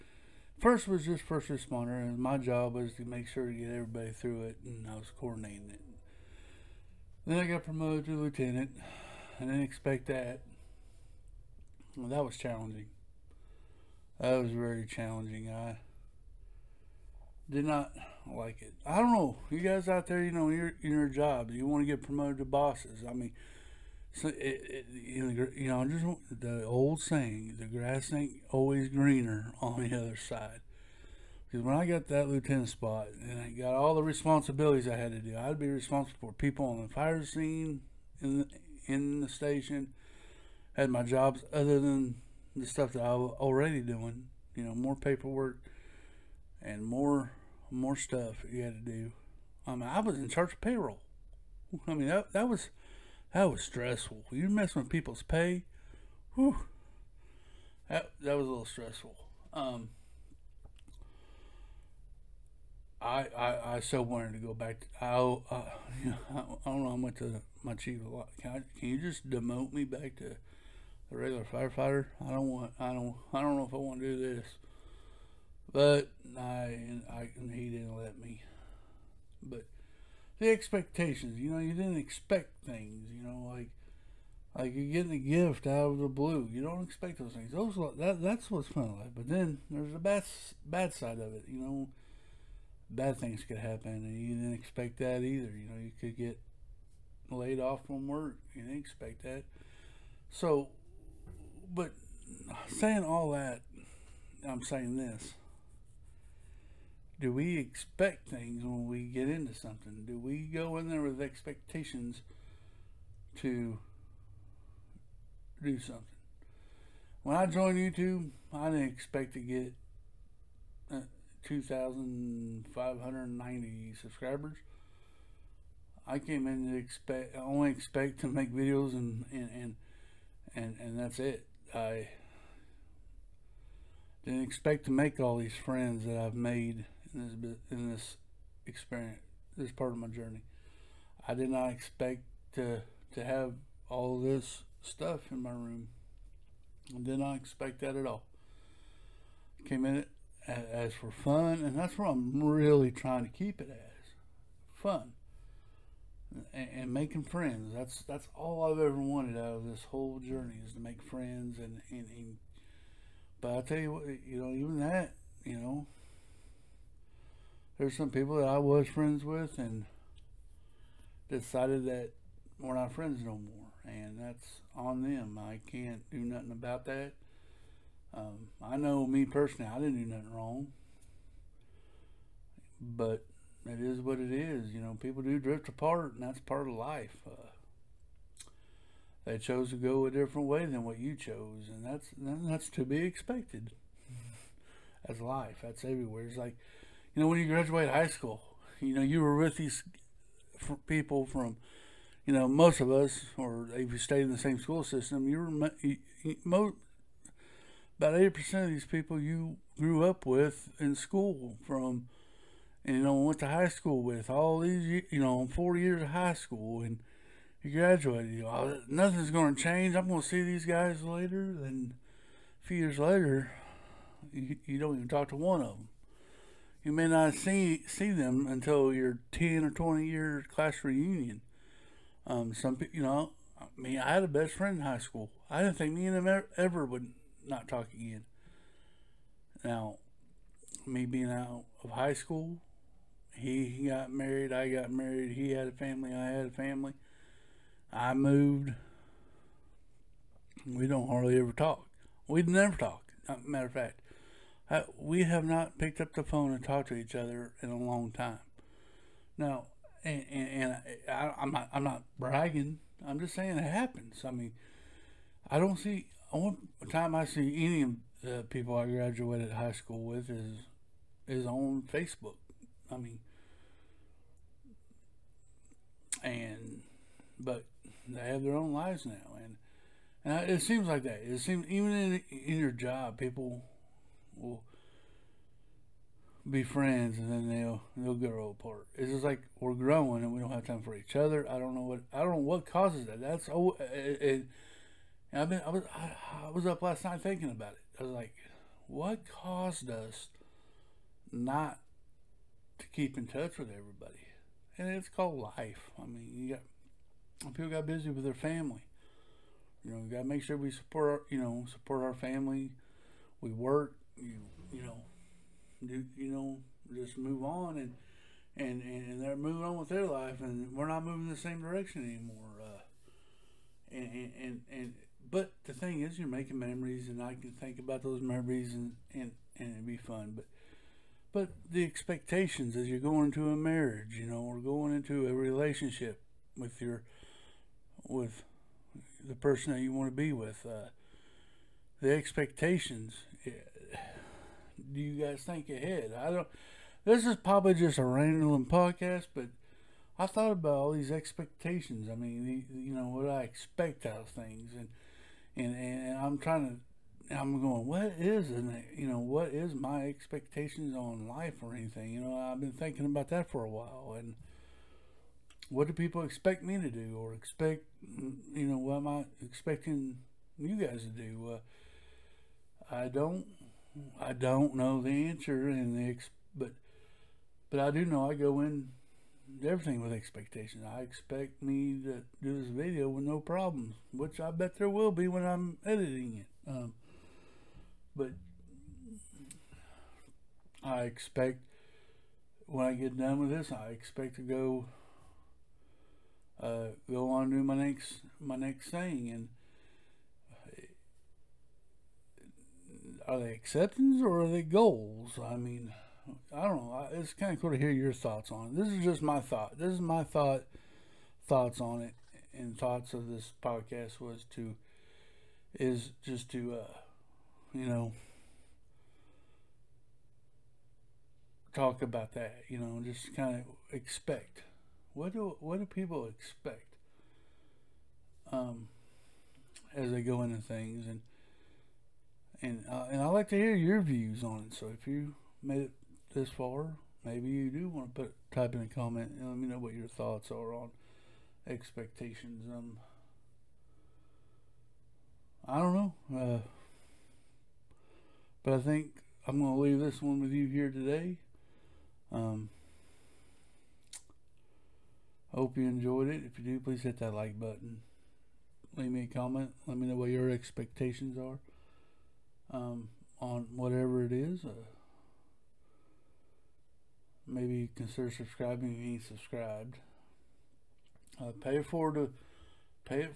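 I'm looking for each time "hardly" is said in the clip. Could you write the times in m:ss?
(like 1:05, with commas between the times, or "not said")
4:11.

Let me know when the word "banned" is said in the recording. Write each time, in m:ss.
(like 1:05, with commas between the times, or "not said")
not said.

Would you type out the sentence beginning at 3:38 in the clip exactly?
You know, nothing's going to change.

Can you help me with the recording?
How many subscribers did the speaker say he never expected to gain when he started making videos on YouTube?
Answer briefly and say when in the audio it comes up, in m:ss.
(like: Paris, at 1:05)
2,590, at 2:01.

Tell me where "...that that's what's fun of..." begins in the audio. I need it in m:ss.
1:27.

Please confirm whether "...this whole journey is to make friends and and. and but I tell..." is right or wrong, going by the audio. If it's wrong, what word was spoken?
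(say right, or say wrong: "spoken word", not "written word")
right.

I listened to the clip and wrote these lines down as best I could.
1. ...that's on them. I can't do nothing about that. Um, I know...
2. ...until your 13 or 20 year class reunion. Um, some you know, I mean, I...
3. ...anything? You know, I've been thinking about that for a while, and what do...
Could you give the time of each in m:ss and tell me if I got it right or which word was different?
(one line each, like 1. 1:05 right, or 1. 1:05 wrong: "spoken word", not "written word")
1. 2:54 right
2. 3:48 wrong: "10", not "13"
3. 6:01 right.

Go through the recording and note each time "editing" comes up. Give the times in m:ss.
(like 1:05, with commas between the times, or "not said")
6:25.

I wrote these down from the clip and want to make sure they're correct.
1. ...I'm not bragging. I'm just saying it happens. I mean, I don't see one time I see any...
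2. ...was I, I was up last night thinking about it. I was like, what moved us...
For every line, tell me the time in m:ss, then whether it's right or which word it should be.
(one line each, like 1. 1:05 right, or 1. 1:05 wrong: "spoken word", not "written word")
1. 4:21 right
2. 4:55 wrong: "caused", not "moved".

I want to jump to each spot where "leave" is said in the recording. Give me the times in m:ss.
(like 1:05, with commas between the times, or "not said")
7:29, 7:38.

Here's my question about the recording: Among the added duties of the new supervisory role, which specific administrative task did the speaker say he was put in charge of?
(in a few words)
Payroll.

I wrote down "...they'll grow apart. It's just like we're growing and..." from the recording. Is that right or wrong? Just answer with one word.
right.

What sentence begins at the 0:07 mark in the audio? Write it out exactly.
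Then I got promoted to lieutenant.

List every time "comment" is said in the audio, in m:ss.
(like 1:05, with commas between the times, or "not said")
7:18, 7:39.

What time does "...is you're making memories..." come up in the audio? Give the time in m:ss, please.
5:26.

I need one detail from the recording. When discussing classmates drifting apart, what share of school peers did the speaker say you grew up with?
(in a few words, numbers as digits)
80 percent.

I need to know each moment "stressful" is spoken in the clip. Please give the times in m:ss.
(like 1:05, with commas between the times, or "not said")
0:53, 0:58.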